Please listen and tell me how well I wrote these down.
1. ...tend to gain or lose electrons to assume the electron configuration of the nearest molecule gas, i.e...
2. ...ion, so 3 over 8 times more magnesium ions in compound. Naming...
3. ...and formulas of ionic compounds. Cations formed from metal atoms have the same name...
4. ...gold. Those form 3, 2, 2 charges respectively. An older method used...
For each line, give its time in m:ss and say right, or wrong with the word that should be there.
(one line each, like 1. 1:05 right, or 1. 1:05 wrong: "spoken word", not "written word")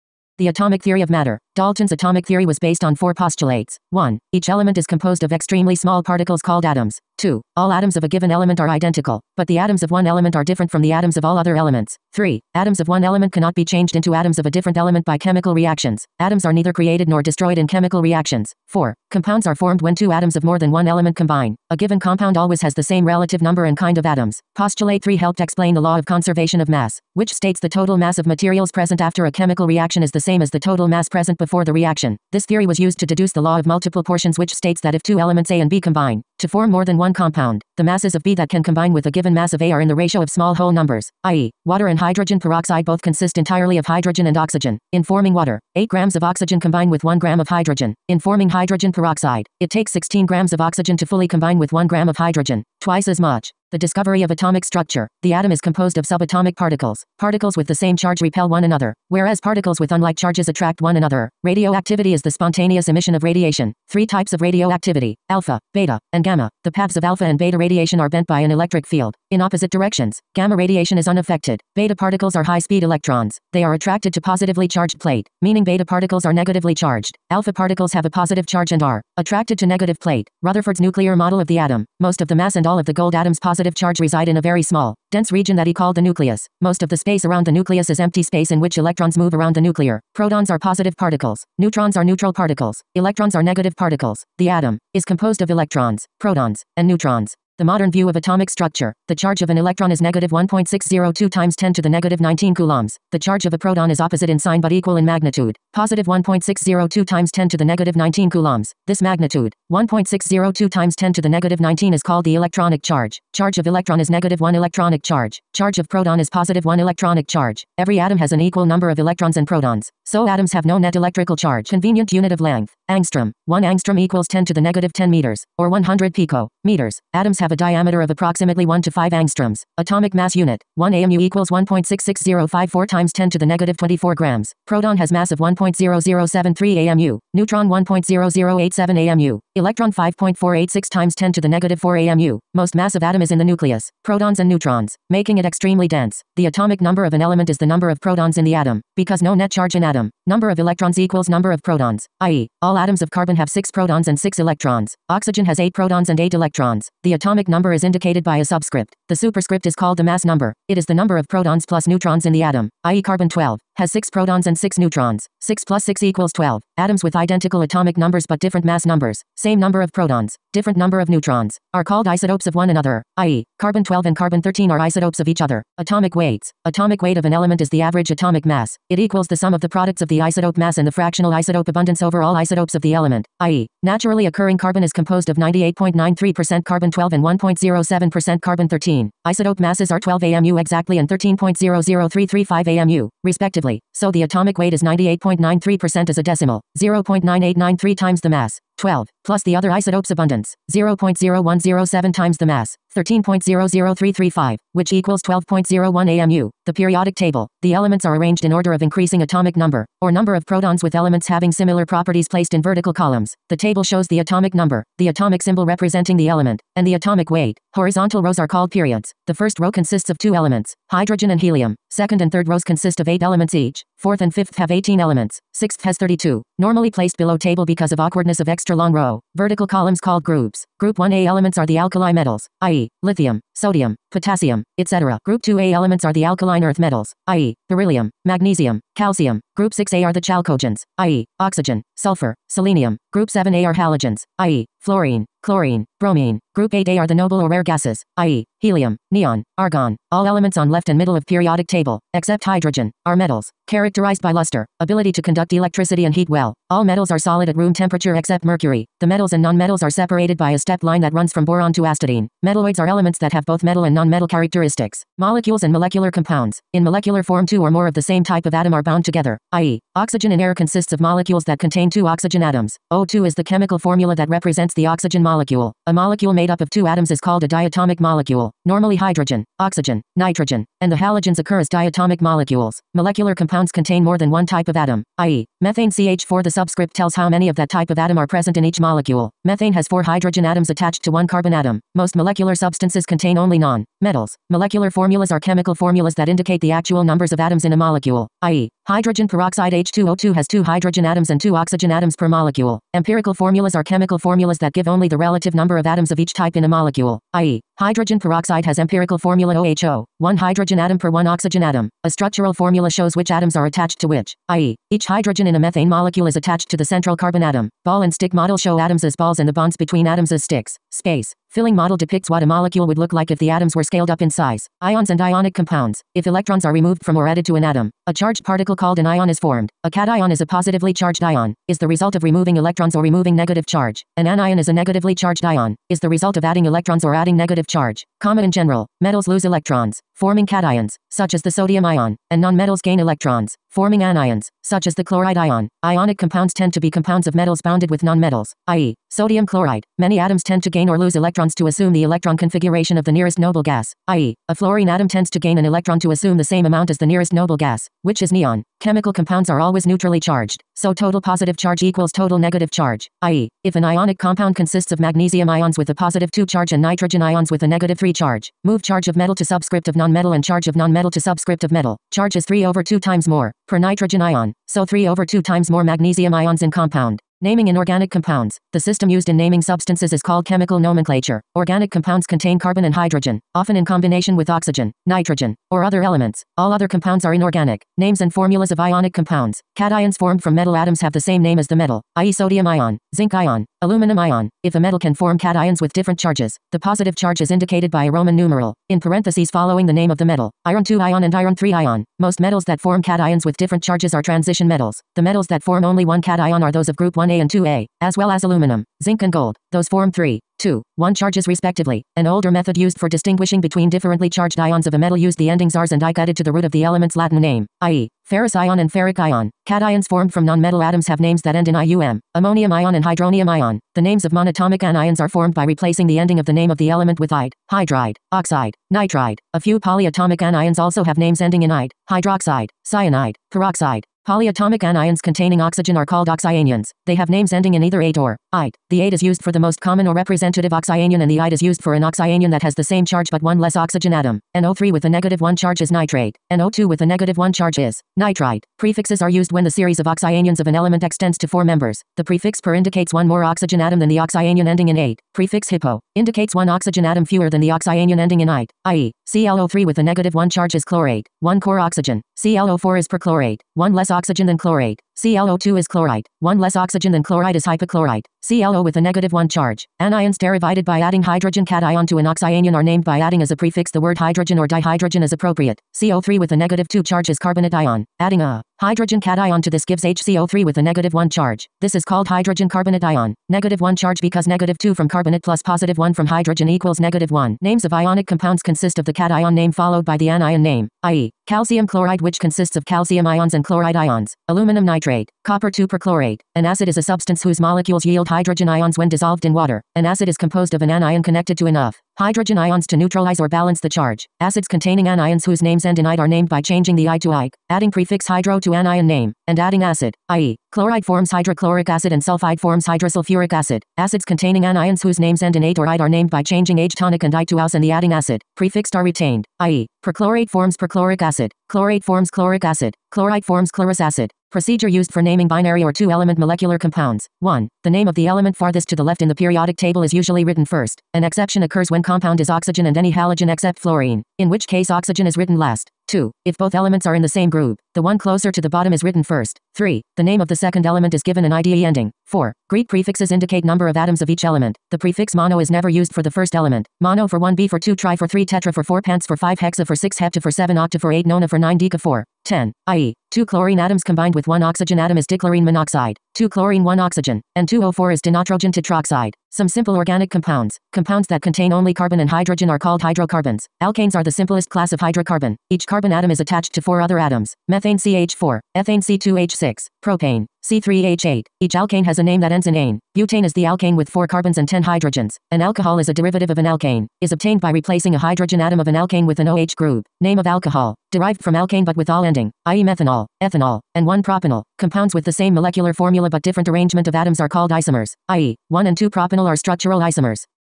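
1. 5:50 wrong: "noble", not "molecule"
2. 6:14 wrong: "2", not "8"
3. 6:28 right
4. 6:49 wrong: "1", not "2".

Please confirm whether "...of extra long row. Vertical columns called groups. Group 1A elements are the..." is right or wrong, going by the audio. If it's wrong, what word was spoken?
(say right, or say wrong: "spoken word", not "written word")
right.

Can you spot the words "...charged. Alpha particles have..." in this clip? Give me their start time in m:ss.
1:16.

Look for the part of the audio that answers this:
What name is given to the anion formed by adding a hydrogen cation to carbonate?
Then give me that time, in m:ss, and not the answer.
8:02.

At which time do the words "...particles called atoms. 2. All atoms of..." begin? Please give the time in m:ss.
0:06.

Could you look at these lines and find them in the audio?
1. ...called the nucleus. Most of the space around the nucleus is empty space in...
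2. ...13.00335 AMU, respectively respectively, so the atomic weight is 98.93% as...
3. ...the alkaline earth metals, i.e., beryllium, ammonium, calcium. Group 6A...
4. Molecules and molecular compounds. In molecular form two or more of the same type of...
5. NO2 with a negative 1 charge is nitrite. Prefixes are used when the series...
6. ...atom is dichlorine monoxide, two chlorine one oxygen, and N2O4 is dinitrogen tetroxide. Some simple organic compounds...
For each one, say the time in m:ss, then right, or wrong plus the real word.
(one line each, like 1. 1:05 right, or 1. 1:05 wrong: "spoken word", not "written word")
1. 1:25 right
2. 3:11 right
3. 3:56 wrong: "magnesium", not "ammonium"
4. 4:25 right
5. 7:26 right
6. 9:14 right.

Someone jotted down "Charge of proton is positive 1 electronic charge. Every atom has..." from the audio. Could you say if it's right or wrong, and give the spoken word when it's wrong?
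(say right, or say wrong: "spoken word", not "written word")
right.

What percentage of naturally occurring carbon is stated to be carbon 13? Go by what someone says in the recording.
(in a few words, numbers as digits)
1.07%.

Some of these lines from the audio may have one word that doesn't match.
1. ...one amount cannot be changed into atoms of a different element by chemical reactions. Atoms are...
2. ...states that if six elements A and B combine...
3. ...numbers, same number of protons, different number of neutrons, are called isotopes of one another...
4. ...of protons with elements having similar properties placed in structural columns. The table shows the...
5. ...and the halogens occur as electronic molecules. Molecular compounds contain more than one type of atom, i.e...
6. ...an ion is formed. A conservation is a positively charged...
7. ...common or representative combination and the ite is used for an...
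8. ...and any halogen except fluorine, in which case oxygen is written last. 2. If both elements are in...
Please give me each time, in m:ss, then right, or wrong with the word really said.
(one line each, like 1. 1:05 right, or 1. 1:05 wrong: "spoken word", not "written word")
1. 0:12 wrong: "element", not "amount"
2. 0:34 wrong: "two", not "six"
3. 2:48 right
4. 3:30 wrong: "vertical", not "structural"
5. 4:40 wrong: "diatomic", not "electronic"
6. 5:28 wrong: "cation", not "conservation"
7. 7:19 wrong: "oxyanion", not "combination"
8. 8:52 right.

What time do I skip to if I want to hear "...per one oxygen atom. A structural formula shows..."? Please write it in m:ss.
5:10.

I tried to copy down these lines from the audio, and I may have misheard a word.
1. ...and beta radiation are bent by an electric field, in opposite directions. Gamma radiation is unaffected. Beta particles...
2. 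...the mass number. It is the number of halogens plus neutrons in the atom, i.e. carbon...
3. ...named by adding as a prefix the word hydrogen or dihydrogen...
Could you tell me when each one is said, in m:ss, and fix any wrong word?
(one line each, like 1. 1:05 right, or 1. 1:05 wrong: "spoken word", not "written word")
1. 1:07 right
2. 2:39 wrong: "protons", not "halogens"
3. 7:52 right.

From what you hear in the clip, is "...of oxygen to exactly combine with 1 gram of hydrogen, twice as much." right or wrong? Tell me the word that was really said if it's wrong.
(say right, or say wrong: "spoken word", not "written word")
wrong: "fully", not "exactly".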